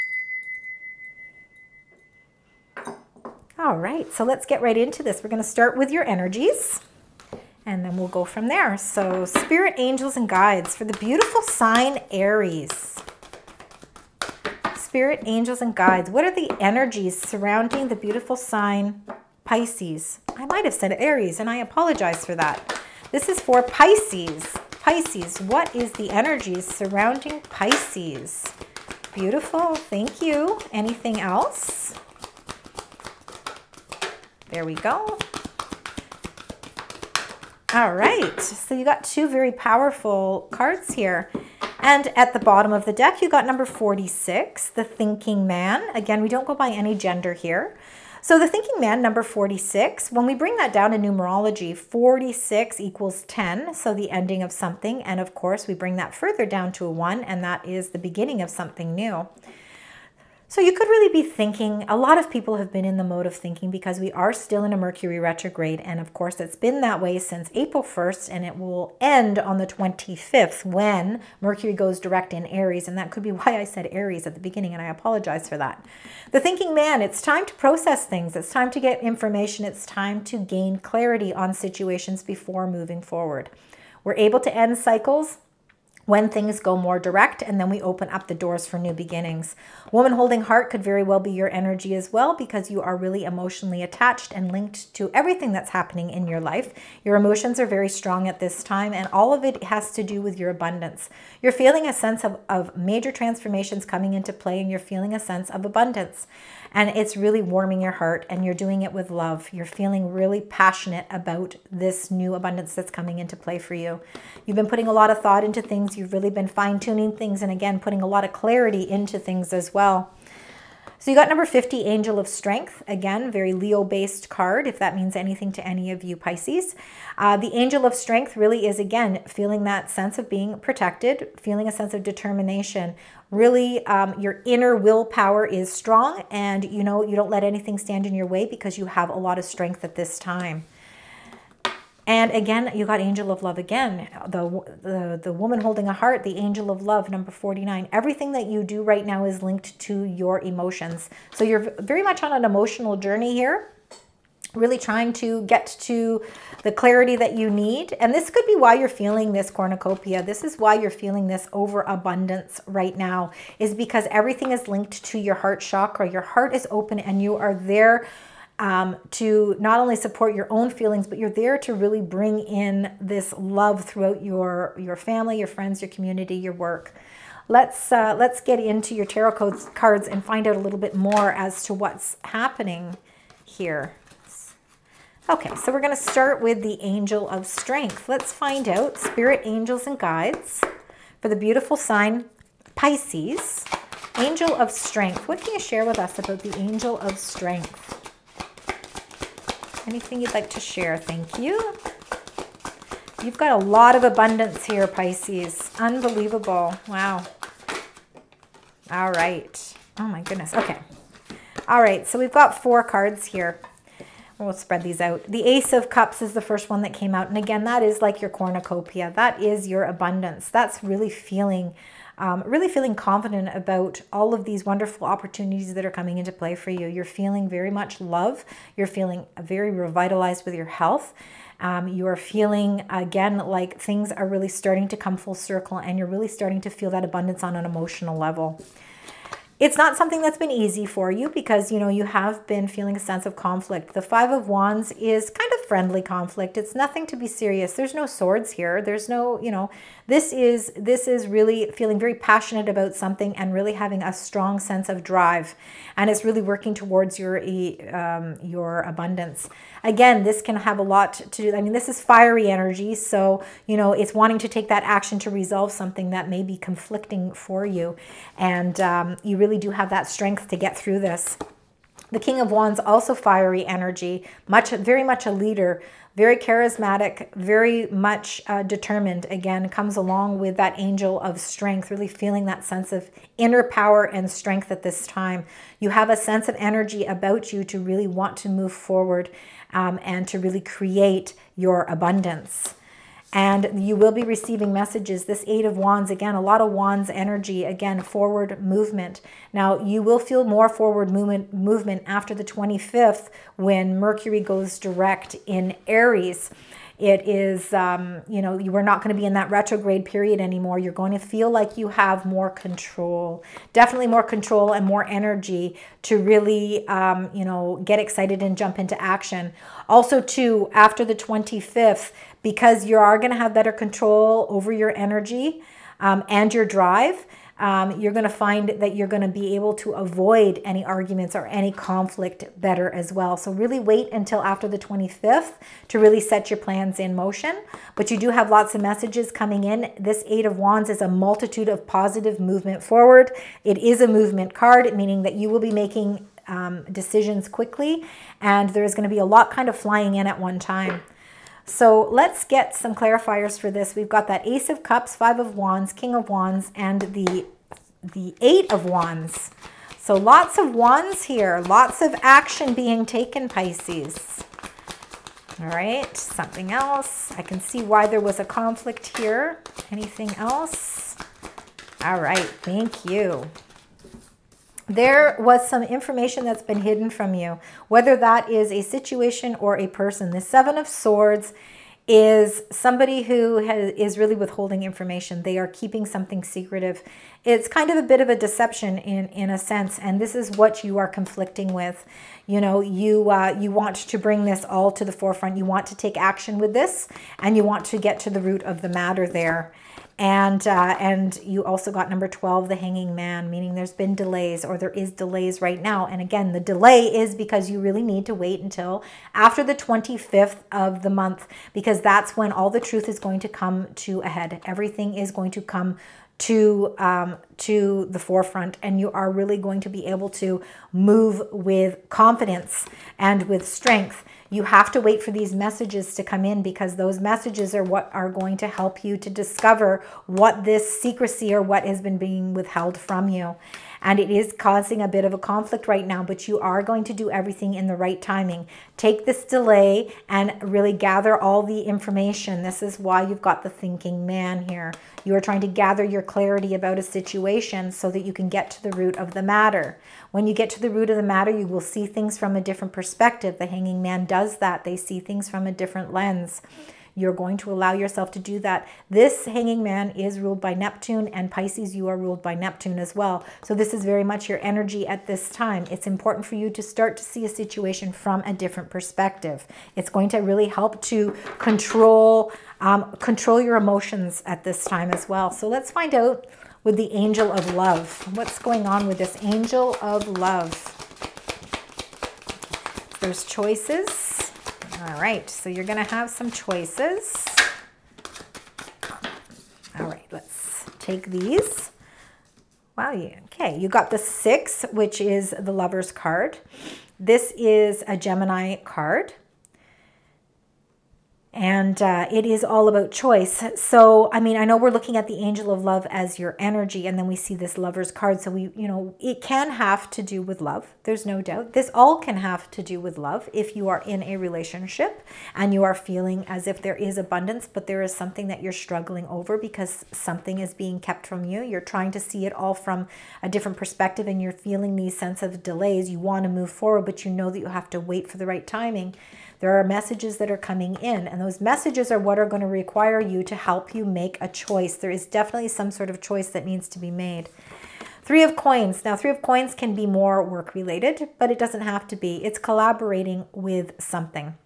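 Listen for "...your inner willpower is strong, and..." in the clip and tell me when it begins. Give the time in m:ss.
2:14.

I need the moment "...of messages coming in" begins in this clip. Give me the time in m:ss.
5:38.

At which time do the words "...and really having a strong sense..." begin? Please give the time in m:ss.
4:13.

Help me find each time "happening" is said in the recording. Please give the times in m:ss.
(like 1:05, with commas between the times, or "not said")
1:35, 3:02.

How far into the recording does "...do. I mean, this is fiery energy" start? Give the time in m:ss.
4:21.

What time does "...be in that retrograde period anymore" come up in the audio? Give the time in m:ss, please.
5:09.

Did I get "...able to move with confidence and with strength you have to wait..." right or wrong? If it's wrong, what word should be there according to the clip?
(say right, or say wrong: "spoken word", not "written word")
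right.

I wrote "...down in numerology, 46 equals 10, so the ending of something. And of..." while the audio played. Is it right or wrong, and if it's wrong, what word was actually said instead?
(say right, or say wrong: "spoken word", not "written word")
right.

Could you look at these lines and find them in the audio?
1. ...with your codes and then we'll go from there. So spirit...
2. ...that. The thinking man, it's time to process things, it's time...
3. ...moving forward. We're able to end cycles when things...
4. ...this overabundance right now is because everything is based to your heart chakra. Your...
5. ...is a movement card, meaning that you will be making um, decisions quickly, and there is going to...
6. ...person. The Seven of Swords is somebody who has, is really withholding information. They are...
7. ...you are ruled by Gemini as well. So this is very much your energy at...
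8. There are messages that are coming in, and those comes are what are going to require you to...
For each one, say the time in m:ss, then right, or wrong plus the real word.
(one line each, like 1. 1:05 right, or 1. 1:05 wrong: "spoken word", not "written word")
1. 0:05 wrong: "energies", not "codes"
2. 1:15 right
3. 1:22 right
4. 2:41 wrong: "linked", not "based"
5. 5:43 right
6. 6:19 right
7. 7:41 wrong: "Neptune", not "Gemini"
8. 8:49 wrong: "messages", not "comes".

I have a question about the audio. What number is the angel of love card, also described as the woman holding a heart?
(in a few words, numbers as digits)
49.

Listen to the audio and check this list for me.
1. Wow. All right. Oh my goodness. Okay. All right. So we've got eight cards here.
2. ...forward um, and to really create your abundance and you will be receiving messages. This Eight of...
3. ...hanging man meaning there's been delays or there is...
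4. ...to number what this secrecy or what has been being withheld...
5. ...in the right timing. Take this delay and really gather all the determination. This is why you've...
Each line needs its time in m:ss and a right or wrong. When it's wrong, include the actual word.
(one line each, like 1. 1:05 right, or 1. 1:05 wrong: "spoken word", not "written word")
1. 3:26 wrong: "four", not "eight"
2. 4:48 right
3. 6:42 right
4. 7:09 wrong: "discover", not "number"
5. 7:17 wrong: "information", not "determination".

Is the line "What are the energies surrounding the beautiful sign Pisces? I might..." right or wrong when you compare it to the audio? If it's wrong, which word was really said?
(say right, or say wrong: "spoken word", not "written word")
right.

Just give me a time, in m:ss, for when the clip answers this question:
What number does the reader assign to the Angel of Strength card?
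2:01.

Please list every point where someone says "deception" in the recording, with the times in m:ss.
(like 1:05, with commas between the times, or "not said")
6:28.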